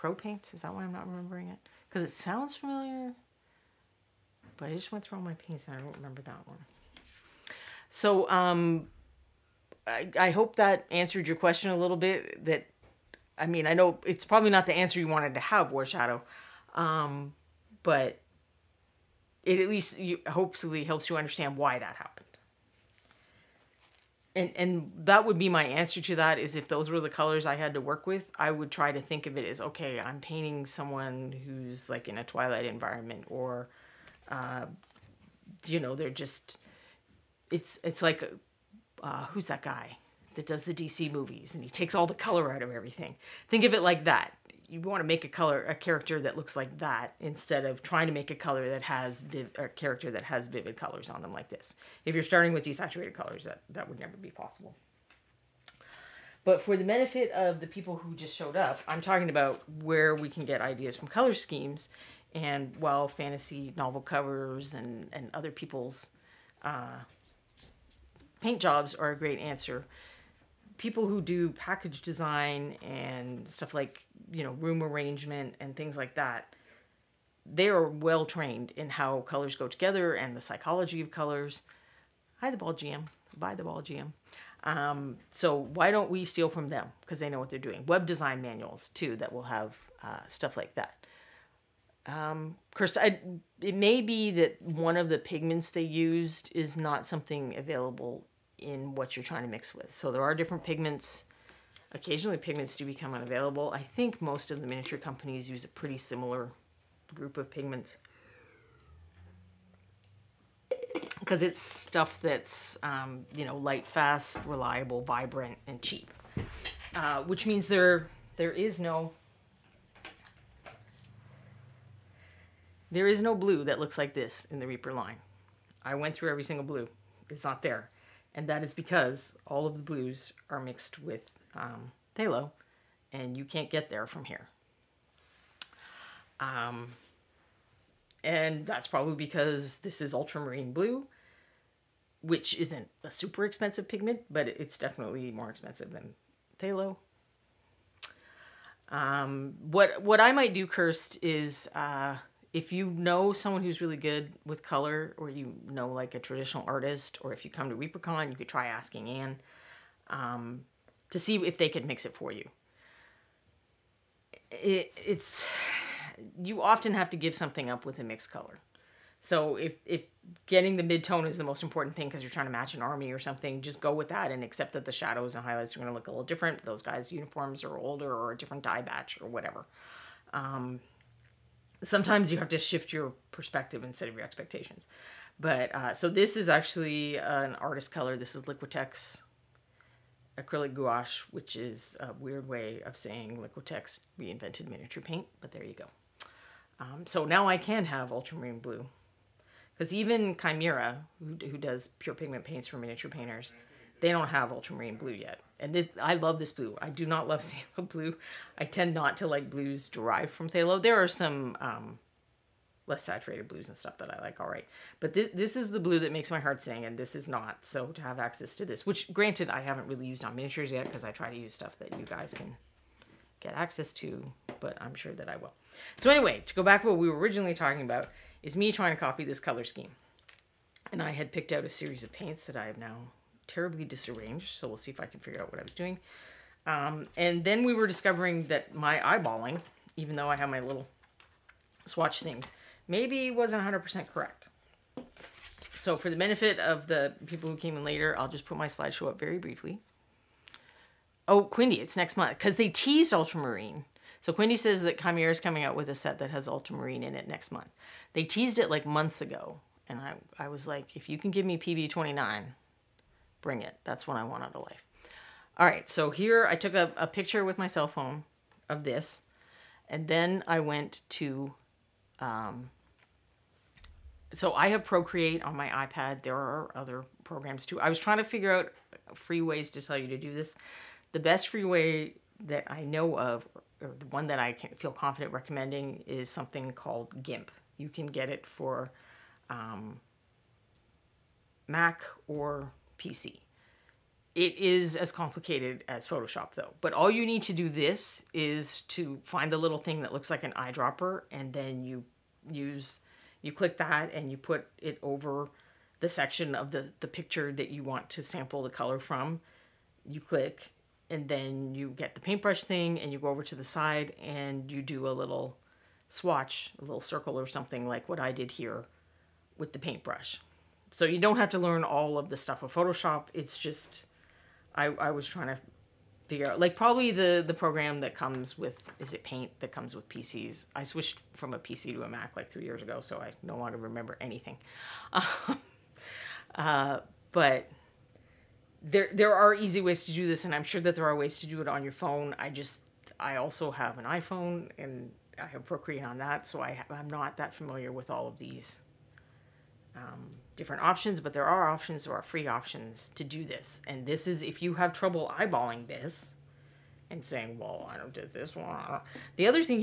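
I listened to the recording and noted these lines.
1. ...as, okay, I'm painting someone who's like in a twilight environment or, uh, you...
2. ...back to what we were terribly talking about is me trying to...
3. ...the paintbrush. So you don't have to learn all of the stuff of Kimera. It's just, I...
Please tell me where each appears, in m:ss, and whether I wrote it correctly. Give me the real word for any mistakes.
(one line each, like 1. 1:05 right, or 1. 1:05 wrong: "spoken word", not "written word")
1. 0:29 right
2. 3:46 wrong: "originally", not "terribly"
3. 5:19 wrong: "Photoshop", not "Kimera".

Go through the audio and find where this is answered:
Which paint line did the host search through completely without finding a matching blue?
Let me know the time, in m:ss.
2:04.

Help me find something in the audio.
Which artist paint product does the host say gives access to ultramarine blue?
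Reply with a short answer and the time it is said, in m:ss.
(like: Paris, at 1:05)
Liquitex acrylic gouache, at 3:08.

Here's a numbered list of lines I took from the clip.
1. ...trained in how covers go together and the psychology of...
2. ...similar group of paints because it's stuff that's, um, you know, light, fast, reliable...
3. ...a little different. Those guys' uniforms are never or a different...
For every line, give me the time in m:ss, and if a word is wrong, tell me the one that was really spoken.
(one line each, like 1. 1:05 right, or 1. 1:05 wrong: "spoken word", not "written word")
1. 1:18 wrong: "colors", not "covers"
2. 1:45 wrong: "pigments", not "paints"
3. 2:56 wrong: "older", not "never".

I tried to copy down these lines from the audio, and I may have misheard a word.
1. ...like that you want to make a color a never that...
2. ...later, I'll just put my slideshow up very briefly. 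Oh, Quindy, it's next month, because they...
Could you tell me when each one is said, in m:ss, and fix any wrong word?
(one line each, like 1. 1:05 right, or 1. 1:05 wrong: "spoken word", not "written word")
1. 0:43 wrong: "character", not "never"
2. 4:07 right.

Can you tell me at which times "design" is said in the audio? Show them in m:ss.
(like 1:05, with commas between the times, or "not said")
1:12, 1:28.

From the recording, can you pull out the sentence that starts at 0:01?
Because it sounds familiar, but I just went through all my paints and I don't remember that one.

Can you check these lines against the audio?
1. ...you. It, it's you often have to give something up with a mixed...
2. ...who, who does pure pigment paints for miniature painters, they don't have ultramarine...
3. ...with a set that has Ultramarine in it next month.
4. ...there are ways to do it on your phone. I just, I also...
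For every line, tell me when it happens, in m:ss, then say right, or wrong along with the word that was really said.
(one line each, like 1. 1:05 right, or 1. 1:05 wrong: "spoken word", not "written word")
1. 2:42 right
2. 3:21 right
3. 4:15 right
4. 5:40 right.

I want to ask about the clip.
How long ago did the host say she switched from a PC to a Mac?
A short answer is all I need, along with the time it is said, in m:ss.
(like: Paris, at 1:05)
3 years, at 5:32.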